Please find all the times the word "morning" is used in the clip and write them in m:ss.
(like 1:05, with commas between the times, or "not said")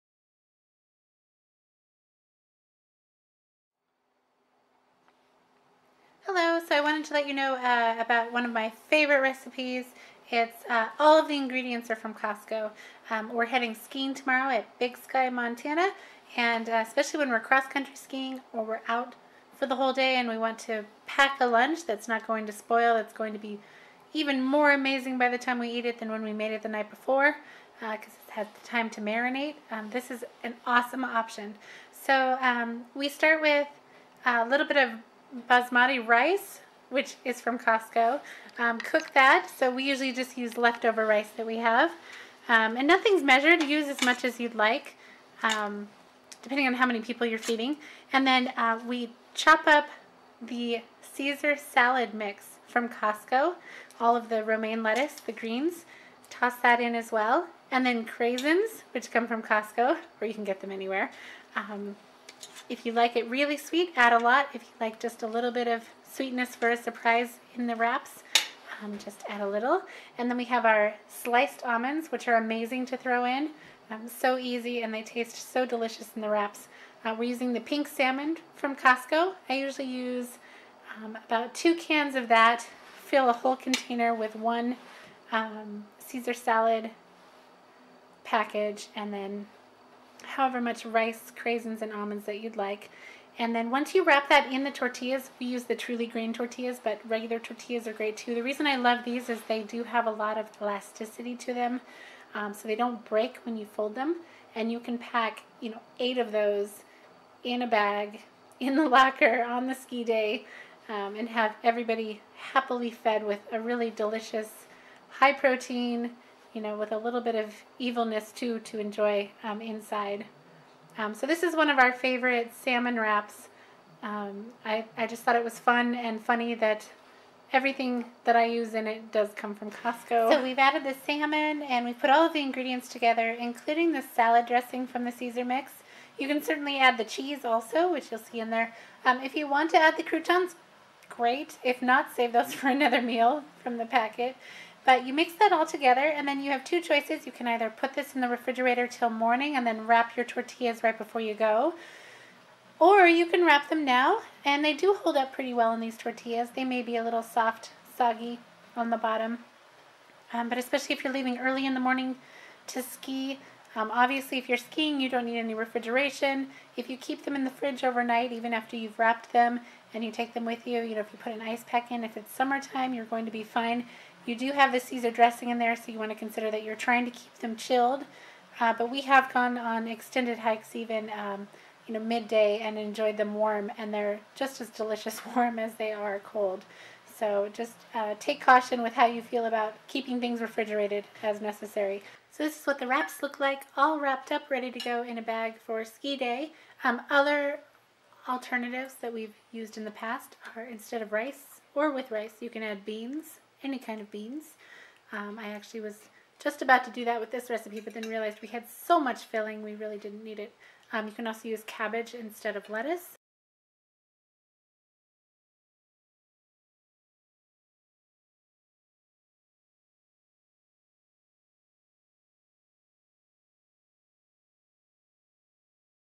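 2:29, 2:41.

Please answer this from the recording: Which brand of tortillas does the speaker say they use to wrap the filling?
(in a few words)
Truly Grain.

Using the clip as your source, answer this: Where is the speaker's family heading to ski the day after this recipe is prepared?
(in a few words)
Big Sky, Montana.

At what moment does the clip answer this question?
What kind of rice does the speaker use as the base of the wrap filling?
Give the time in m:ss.
0:35.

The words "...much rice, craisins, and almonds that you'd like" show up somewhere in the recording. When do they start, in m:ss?
1:30.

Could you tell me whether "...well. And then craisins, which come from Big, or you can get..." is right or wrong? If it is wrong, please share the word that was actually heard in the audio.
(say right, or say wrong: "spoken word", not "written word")
wrong: "Costco", not "Big".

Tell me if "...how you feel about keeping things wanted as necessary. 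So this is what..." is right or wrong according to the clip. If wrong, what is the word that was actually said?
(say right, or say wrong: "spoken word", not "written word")
wrong: "refrigerated", not "wanted".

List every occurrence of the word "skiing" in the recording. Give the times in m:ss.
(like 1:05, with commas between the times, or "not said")
0:13, 0:17, 2:44.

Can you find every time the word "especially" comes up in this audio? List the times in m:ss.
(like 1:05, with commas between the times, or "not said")
0:16, 2:40.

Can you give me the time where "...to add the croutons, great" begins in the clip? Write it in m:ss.
2:19.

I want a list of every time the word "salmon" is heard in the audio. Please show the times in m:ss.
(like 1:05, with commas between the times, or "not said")
1:17, 2:02, 2:11.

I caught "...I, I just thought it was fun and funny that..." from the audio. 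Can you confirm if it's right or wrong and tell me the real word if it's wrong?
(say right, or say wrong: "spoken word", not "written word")
right.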